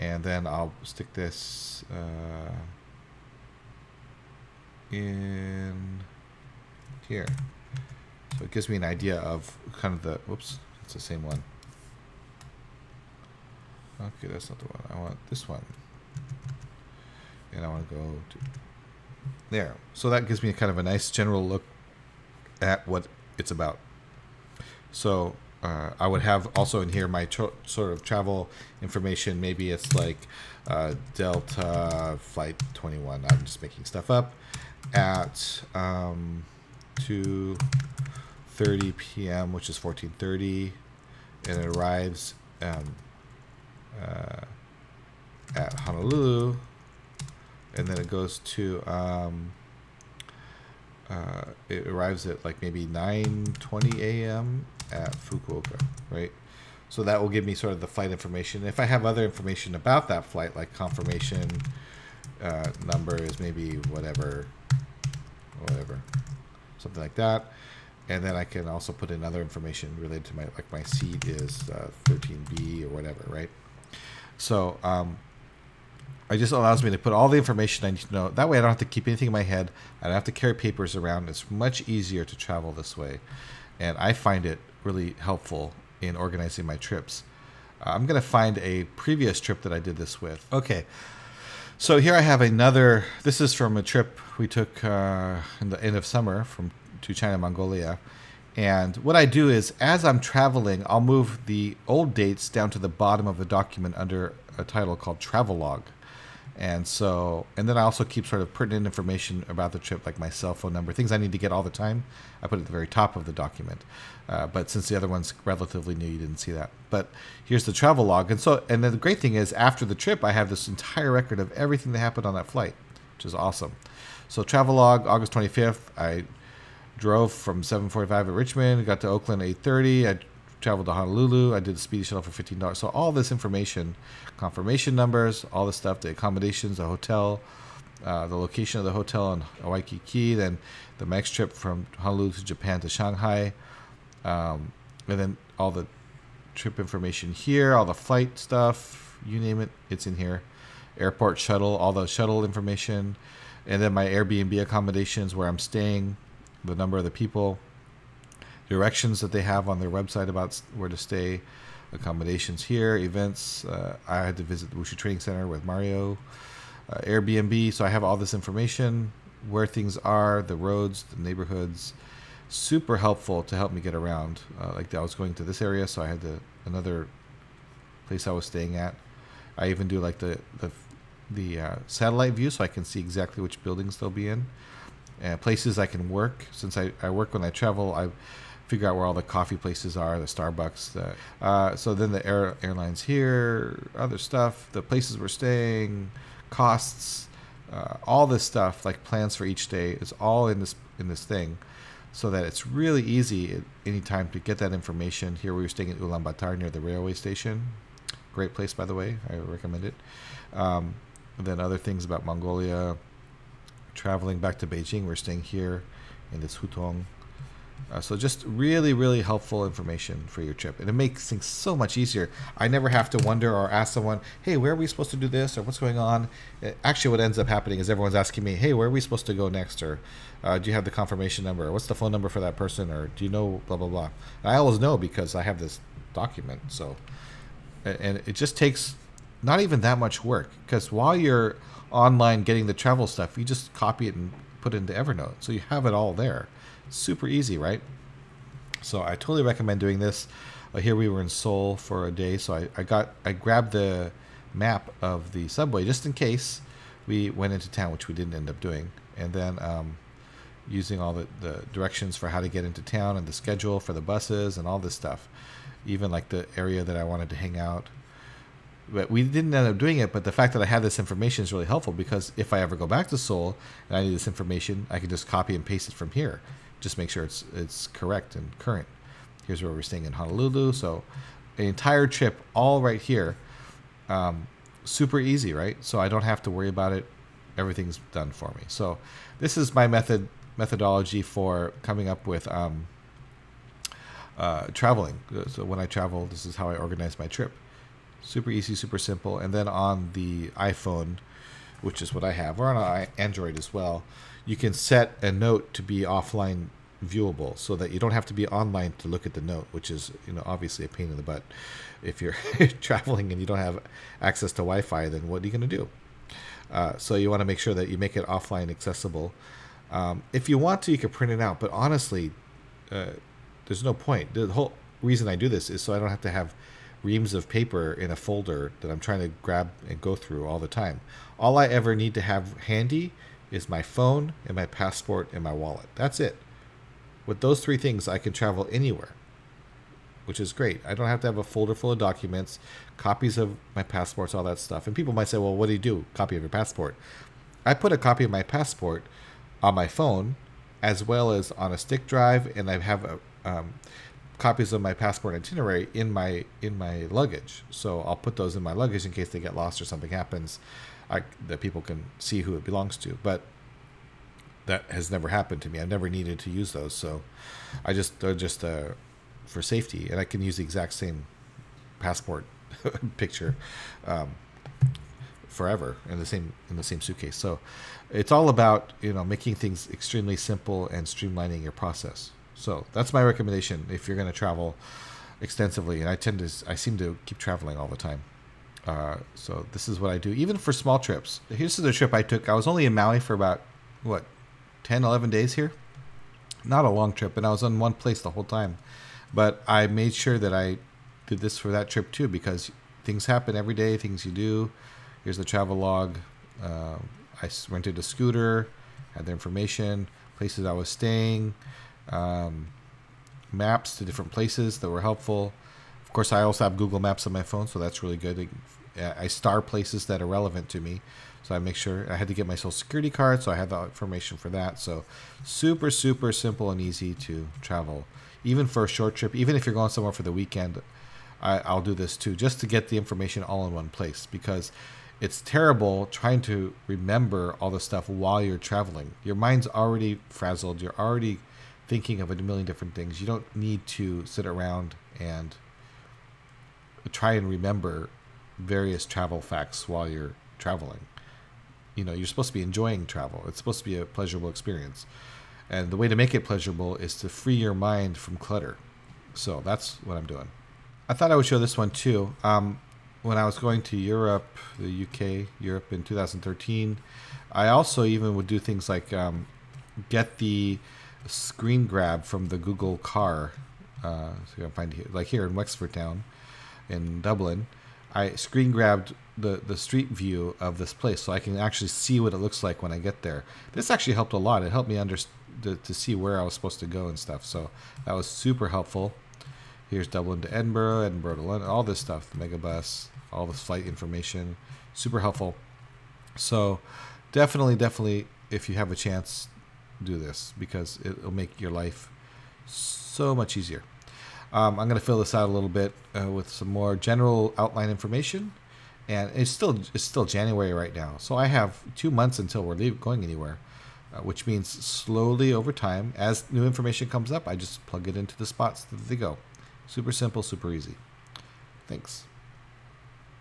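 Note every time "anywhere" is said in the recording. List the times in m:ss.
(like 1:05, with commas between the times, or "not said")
5:38, 8:33.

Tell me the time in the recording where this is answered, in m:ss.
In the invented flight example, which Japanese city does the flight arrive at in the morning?
0:55.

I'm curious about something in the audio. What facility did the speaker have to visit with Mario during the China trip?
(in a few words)
Wushu Training Center.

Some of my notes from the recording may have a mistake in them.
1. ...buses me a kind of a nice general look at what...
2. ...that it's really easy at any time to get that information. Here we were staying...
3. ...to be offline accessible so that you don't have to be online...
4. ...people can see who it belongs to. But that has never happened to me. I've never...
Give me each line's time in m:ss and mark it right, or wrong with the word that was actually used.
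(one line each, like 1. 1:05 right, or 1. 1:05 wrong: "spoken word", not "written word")
1. 0:20 wrong: "gives", not "buses"
2. 3:22 right
3. 5:05 wrong: "viewable", not "accessible"
4. 6:01 right.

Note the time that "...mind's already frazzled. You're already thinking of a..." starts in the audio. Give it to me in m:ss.
7:19.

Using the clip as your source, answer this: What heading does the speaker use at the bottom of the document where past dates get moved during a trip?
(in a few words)
Travelog.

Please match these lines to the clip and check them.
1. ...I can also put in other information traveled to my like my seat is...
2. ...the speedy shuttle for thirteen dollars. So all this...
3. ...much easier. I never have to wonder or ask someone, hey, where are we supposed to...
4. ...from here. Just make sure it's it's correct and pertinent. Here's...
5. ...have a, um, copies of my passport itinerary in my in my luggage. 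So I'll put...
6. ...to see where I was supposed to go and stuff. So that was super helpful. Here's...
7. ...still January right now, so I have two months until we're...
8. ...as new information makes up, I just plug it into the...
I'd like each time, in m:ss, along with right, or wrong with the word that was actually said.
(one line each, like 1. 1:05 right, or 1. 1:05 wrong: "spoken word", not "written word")
1. 1:08 wrong: "related", not "traveled"
2. 2:11 wrong: "fifteen", not "thirteen"
3. 3:41 right
4. 4:35 wrong: "current", not "pertinent"
5. 5:52 right
6. 8:05 right
7. 8:30 right
8. 8:36 wrong: "comes", not "makes".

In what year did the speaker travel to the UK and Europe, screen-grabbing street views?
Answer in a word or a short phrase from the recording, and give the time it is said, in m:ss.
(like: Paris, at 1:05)
2013, at 7:46.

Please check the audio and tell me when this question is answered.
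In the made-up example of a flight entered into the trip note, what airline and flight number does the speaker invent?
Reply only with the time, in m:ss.
0:31.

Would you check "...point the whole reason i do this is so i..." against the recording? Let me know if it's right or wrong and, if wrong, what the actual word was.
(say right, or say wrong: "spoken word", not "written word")
right.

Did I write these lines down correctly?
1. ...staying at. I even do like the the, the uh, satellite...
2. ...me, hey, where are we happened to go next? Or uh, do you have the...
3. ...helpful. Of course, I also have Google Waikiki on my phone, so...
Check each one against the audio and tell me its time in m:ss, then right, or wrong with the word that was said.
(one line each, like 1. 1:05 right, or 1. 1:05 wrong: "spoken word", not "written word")
1. 2:58 right
2. 3:48 wrong: "supposed", not "happened"
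3. 6:55 wrong: "Maps", not "Waikiki".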